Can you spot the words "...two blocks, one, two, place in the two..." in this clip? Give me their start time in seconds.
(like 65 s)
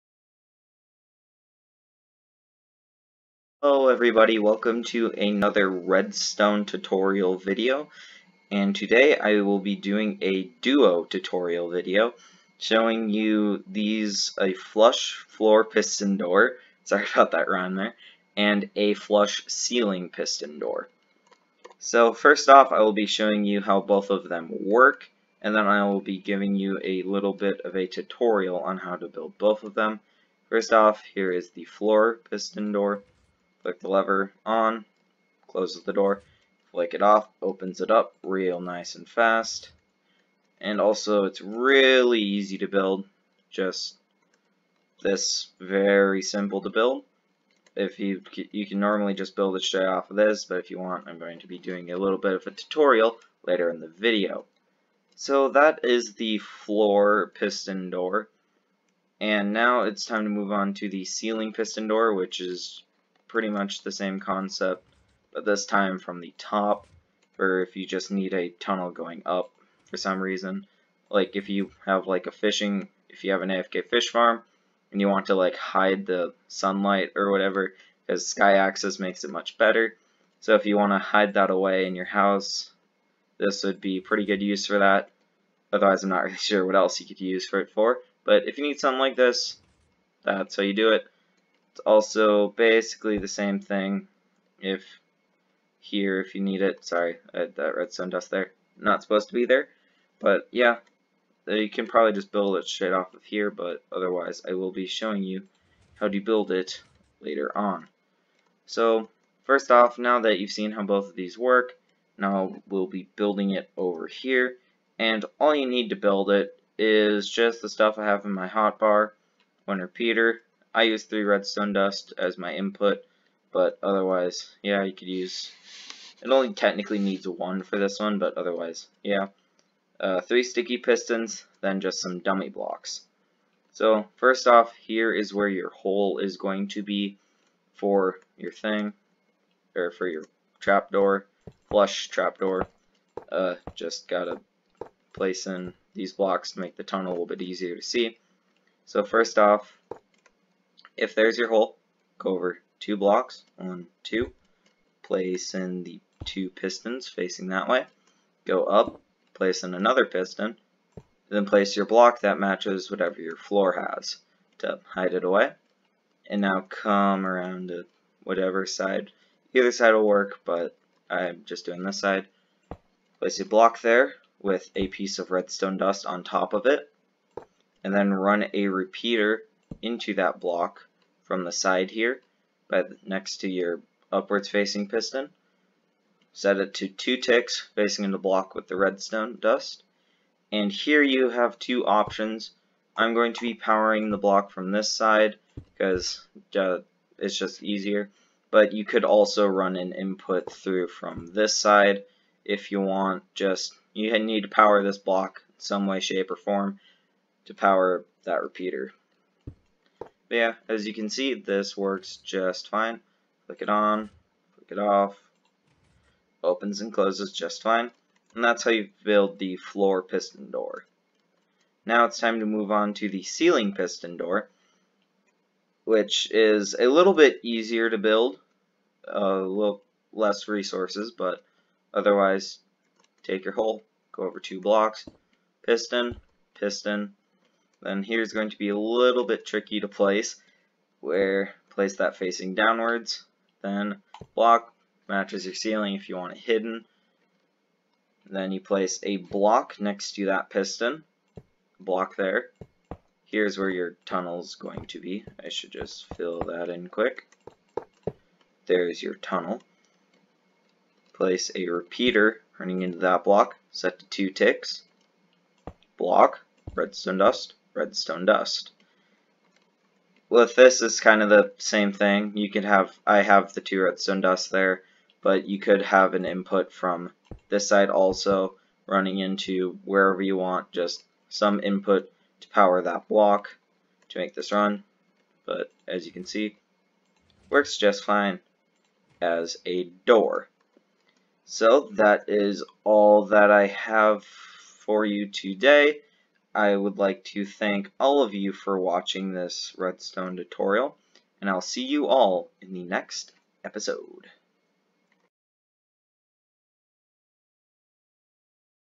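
152 s.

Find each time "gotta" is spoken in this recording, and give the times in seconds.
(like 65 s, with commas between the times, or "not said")
144 s.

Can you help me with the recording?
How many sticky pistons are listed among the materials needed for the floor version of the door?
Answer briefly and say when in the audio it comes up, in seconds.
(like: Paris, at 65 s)
3, at 130 s.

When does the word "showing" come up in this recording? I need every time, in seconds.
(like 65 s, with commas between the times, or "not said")
12 s, 23 s, 104 s.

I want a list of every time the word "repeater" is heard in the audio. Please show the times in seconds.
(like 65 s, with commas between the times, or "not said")
119 s, 178 s, 208 s, 261 s.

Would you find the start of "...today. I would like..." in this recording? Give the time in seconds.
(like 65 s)
295 s.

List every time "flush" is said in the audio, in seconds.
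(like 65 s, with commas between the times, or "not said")
14 s, 18 s, 141 s.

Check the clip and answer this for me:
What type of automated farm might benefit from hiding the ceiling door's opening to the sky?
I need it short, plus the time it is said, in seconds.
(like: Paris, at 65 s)
AFK fish farm, at 73 s.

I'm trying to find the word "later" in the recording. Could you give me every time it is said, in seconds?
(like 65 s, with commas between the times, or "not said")
53 s, 107 s.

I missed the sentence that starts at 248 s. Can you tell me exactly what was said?
Then you place a block next to that piston, block there.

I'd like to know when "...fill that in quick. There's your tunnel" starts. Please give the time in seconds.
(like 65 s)
256 s.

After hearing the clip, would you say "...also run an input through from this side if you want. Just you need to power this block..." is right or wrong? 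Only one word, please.
right.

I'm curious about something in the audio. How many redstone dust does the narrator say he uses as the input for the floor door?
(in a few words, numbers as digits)
3.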